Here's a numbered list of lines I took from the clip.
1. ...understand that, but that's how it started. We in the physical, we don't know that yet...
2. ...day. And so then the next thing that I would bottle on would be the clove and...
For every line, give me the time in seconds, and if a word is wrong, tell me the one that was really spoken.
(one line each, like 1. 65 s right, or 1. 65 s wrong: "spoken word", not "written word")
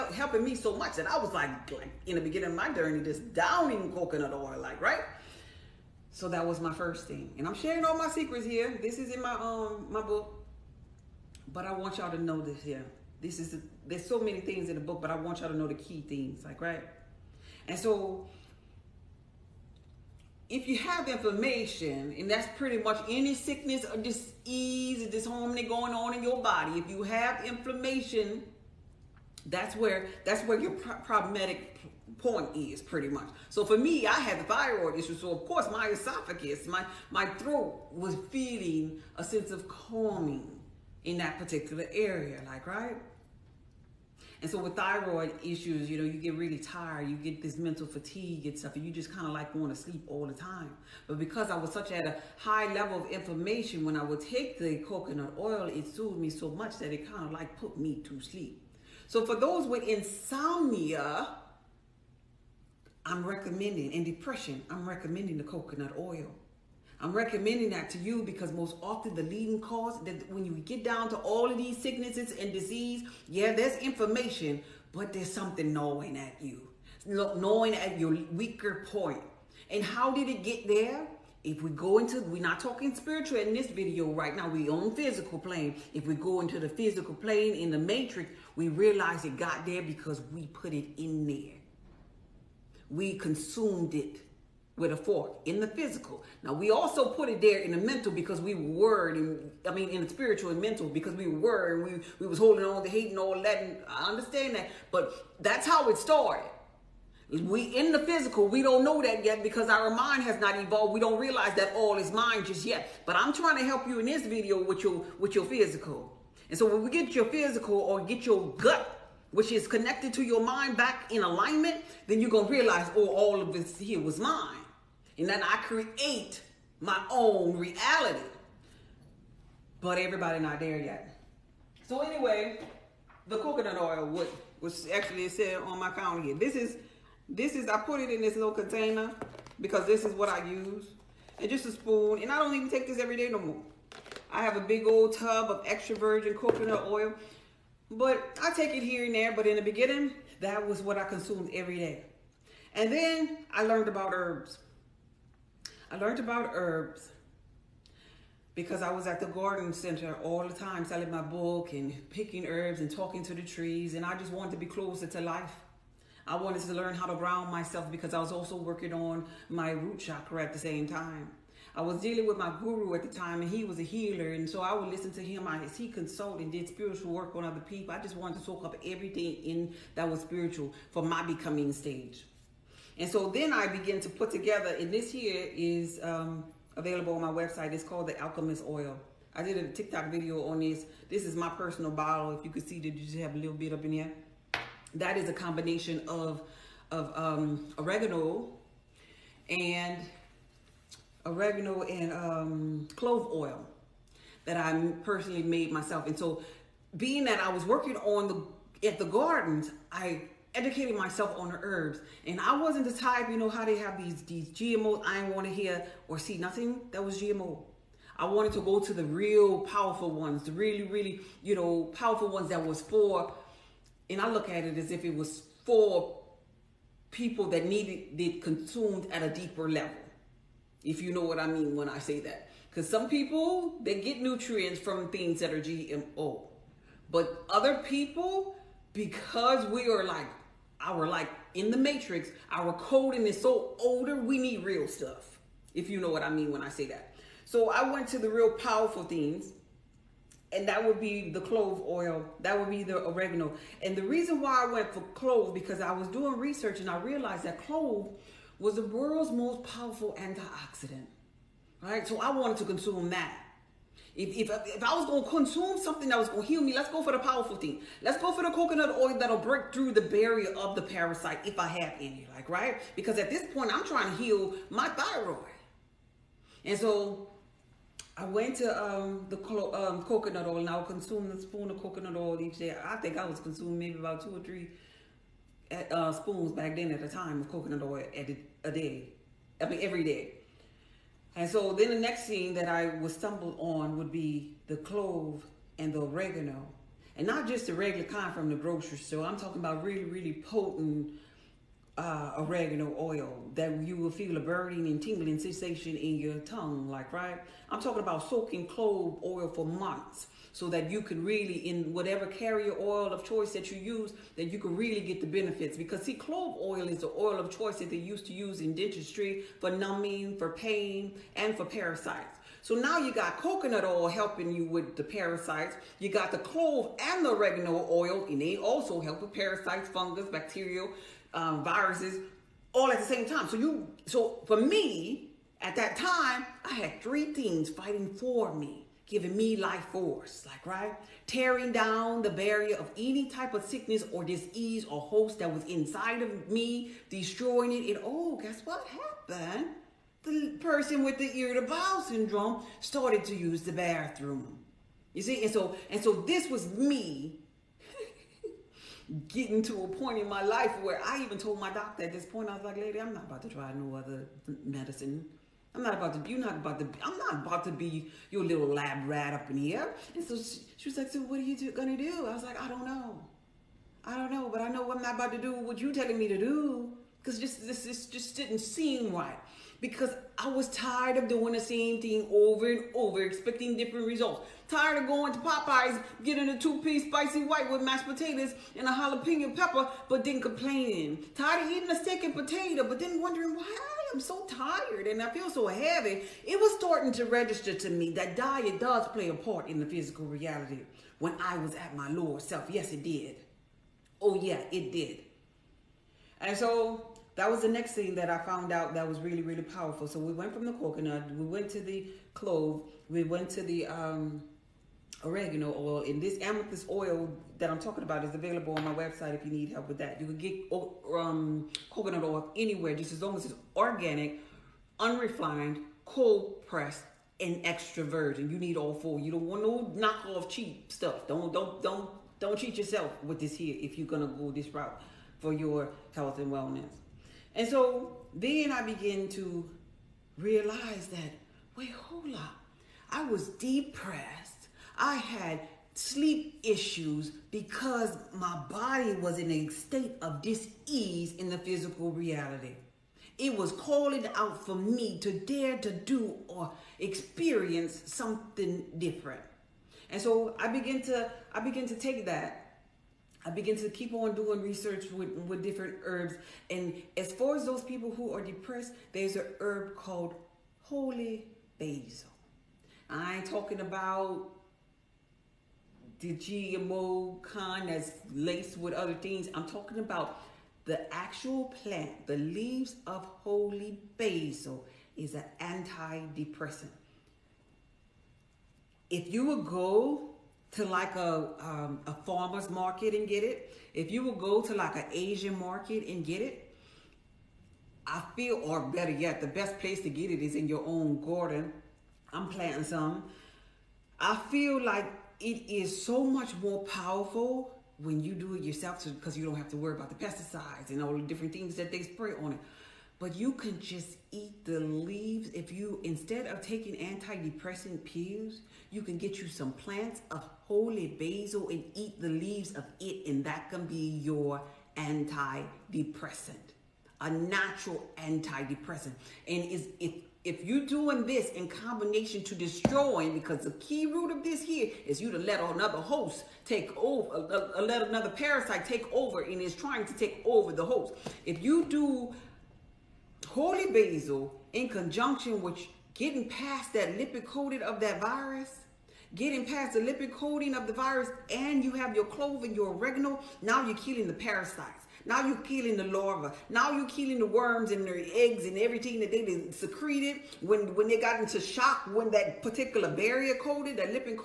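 1. 104 s right
2. 290 s wrong: "stumble", not "bottle".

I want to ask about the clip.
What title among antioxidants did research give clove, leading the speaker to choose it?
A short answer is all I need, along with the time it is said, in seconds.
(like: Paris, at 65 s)
World's most powerful antioxidant, at 258 s.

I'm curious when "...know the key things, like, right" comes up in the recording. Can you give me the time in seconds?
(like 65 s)
15 s.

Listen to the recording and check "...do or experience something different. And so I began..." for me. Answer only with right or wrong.
right.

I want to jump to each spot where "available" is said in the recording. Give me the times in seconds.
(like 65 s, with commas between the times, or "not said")
186 s, 418 s.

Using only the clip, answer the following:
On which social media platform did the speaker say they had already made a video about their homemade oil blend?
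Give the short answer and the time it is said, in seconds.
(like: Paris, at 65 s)
TikTok, at 189 s.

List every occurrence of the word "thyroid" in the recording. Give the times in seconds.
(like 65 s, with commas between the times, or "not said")
34 s, 44 s, 274 s.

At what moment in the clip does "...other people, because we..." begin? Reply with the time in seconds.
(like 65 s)
237 s.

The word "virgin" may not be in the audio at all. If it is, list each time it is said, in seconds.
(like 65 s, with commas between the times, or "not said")
145 s, 428 s.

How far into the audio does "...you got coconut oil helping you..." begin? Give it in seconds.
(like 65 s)
322 s.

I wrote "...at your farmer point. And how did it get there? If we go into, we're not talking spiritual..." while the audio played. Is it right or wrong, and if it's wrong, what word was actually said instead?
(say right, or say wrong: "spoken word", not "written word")
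wrong: "weaker", not "farmer".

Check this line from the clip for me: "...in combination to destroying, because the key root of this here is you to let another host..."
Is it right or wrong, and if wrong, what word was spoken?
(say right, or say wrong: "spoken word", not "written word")
right.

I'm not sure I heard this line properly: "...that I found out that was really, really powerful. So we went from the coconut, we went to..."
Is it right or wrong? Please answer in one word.
right.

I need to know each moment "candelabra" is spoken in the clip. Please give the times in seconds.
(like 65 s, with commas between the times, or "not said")
not said.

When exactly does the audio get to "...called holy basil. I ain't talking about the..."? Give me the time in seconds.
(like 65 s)
469 s.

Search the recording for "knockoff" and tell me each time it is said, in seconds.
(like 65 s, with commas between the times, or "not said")
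429 s.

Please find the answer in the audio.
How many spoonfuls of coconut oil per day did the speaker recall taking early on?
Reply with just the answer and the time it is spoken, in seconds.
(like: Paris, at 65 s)
2 or 3, at 284 s.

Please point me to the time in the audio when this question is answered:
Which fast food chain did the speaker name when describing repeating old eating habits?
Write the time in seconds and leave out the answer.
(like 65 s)
385 s.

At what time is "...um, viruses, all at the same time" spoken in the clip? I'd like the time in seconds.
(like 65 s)
331 s.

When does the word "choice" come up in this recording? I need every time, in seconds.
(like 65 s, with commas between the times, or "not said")
313 s, 317 s.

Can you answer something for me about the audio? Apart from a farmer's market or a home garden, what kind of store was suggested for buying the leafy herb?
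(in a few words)
Asian market.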